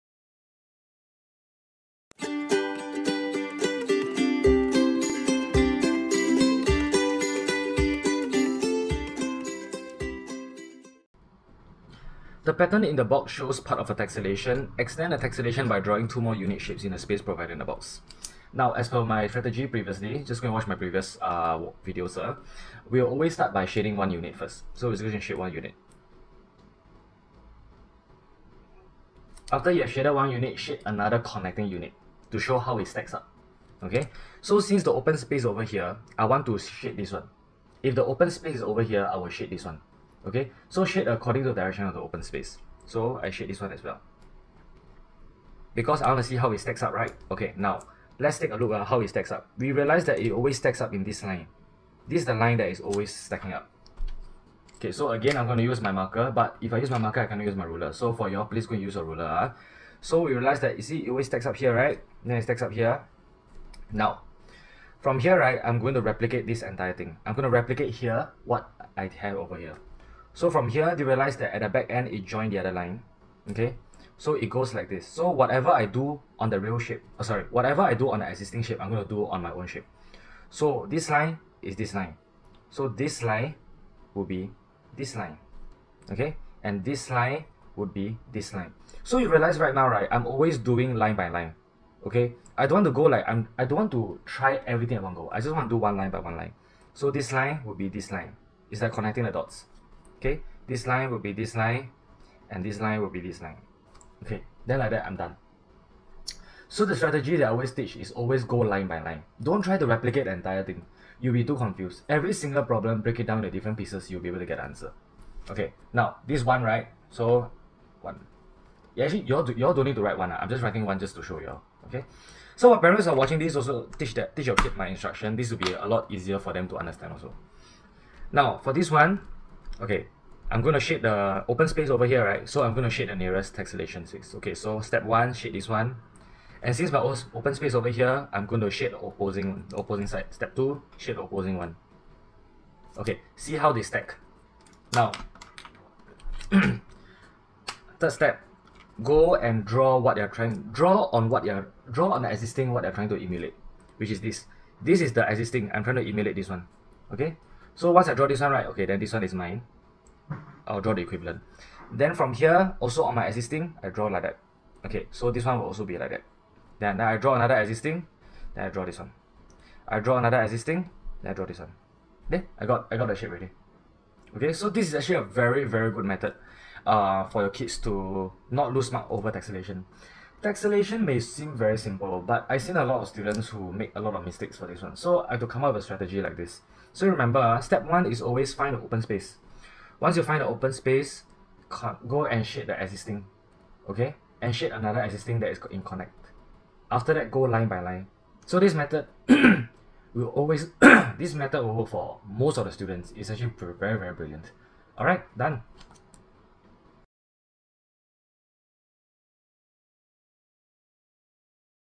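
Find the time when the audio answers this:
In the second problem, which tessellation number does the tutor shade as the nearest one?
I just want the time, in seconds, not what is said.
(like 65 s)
134 s.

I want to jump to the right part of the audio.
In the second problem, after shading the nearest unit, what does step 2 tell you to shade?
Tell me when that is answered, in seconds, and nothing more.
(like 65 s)
141 s.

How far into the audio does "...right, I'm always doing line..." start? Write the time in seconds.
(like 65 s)
89 s.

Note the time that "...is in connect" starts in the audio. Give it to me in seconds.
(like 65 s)
195 s.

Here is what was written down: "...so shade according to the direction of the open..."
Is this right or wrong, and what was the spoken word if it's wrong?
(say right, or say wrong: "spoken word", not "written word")
right.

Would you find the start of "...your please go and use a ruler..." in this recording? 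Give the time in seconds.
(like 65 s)
58 s.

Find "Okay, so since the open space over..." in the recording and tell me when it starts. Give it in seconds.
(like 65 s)
33 s.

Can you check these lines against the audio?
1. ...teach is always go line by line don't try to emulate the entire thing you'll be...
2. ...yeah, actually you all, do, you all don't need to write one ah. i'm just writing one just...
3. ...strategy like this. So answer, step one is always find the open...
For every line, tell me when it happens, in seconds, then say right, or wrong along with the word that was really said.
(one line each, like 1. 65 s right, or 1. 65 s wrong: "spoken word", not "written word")
1. 107 s wrong: "replicate", not "emulate"
2. 118 s right
3. 185 s wrong: "remember", not "answer".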